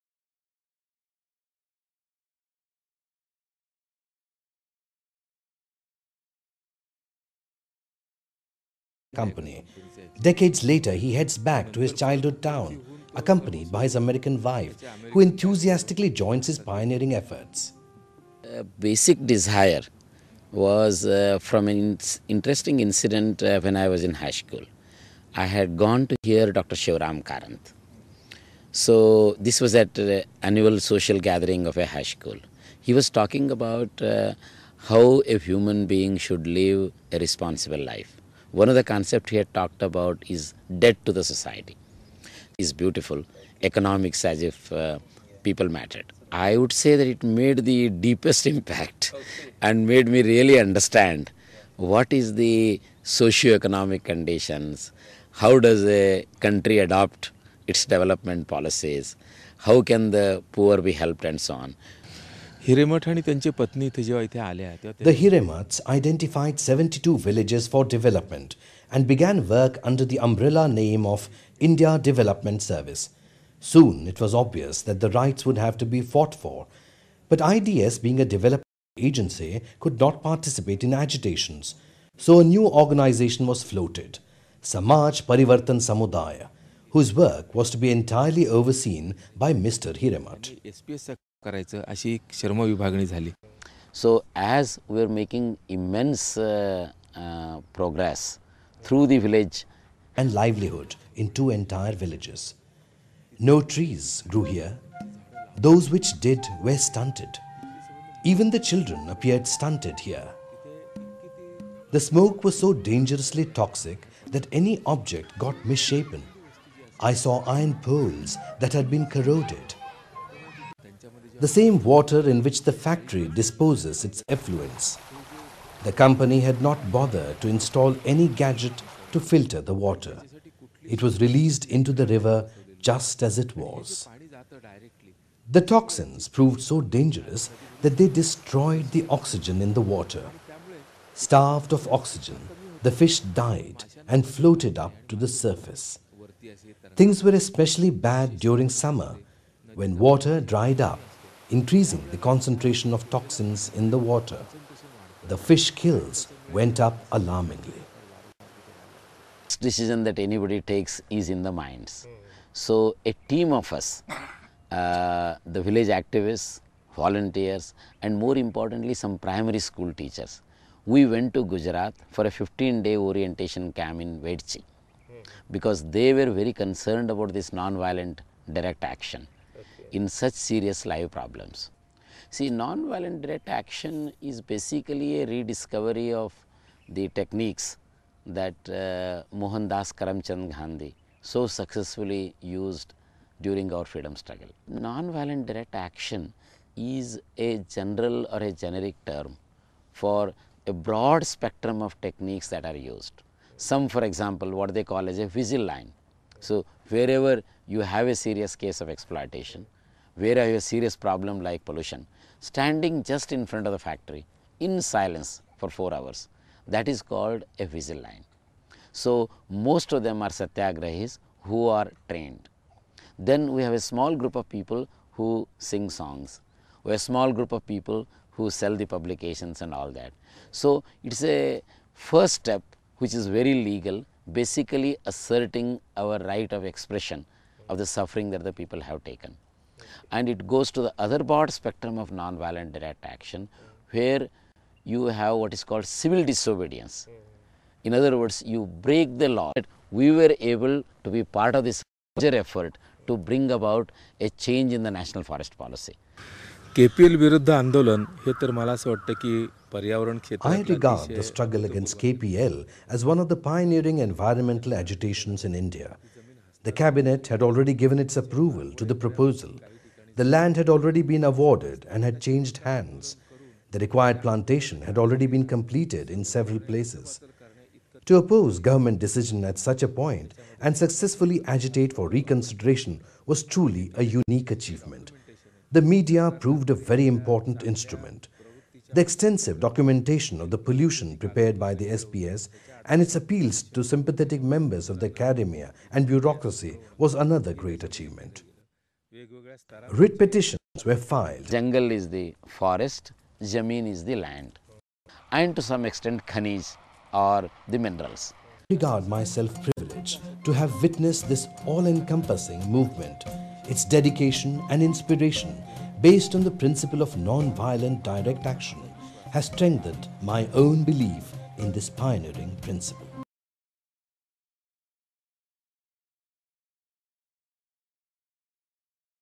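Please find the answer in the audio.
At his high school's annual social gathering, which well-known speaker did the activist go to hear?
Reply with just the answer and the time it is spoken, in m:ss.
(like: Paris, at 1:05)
Dr. Shivaram Karanth, at 0:26.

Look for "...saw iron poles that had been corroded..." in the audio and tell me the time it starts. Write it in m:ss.
1:57.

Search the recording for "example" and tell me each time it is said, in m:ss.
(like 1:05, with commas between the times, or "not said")
3:24.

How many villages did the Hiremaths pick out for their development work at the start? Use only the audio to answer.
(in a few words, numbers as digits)
72.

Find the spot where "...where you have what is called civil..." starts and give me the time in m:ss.
4:03.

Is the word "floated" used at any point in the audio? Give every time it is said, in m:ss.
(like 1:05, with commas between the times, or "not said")
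1:23, 2:24.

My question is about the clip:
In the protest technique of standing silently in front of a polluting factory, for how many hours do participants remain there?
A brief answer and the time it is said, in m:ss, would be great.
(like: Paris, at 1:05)
4, at 3:35.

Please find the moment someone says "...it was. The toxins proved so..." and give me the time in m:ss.
2:13.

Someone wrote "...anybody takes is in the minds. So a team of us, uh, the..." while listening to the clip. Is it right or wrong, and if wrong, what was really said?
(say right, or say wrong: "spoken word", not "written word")
right.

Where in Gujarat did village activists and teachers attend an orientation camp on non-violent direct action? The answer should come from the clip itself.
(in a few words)
Vedchi.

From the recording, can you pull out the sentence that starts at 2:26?
Things were especially bad during summer when water dried up increasing the concentration of toxins in the water.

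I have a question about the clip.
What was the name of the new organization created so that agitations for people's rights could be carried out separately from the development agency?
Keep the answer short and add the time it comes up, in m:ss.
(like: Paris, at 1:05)
Samaj Parivartan Samudaya, at 1:24.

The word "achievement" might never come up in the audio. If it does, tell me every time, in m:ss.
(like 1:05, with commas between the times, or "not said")
4:44, 4:57.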